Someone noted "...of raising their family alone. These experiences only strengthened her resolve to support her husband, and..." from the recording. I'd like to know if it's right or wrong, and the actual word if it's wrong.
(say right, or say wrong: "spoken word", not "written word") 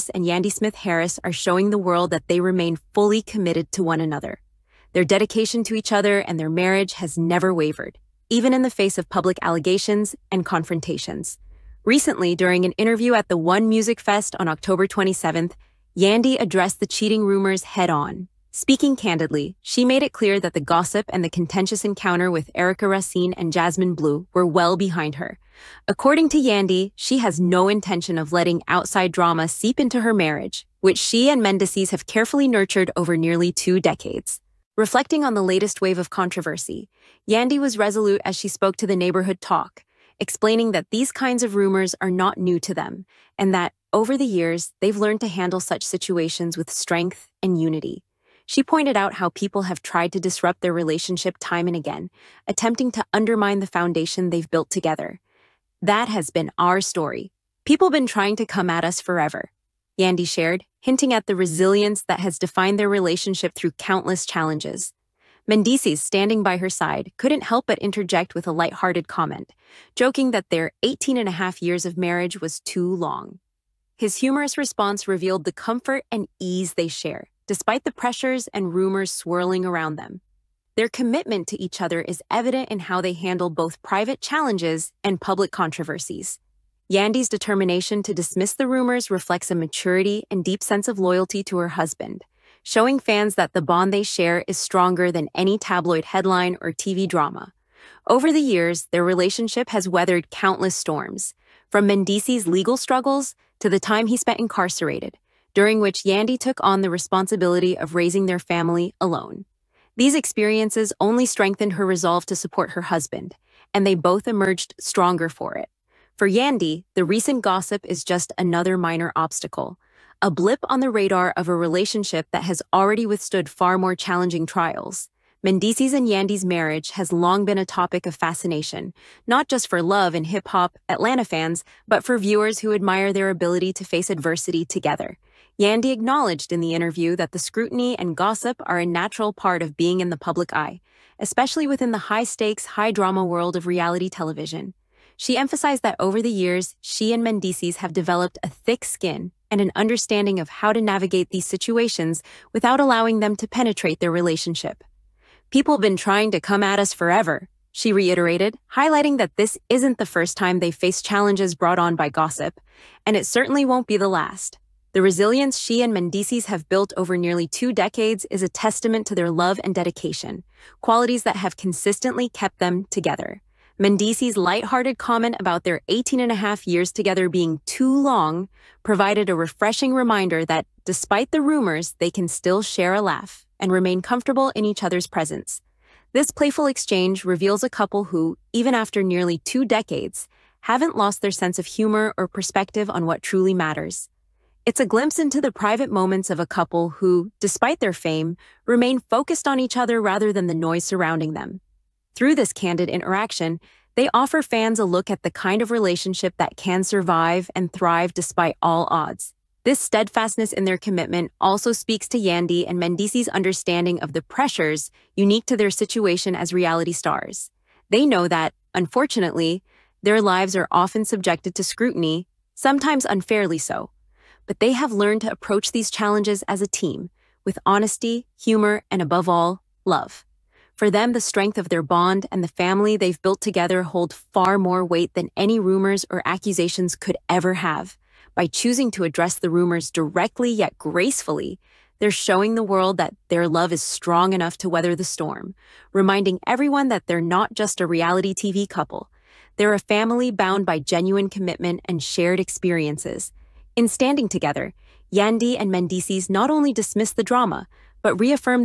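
right.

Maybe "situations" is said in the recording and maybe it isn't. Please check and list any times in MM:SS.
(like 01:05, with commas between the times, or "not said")
00:45, 02:31, 03:35.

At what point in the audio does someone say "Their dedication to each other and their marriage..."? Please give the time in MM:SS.
00:04.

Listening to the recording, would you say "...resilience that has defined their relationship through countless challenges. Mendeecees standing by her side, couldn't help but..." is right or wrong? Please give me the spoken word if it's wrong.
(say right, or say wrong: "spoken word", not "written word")
right.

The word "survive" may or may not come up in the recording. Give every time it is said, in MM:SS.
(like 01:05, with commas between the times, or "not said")
03:26.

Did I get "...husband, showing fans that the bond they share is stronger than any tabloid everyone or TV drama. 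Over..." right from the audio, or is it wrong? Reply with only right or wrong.
wrong.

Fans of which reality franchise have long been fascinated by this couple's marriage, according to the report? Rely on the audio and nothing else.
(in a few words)
Love and Hip Hop Atlanta.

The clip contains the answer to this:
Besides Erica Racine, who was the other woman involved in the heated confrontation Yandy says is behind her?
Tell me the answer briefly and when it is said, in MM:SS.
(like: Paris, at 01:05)
Jasmine Bleu, at 00:23.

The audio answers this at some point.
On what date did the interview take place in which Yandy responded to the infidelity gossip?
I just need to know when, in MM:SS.
00:14.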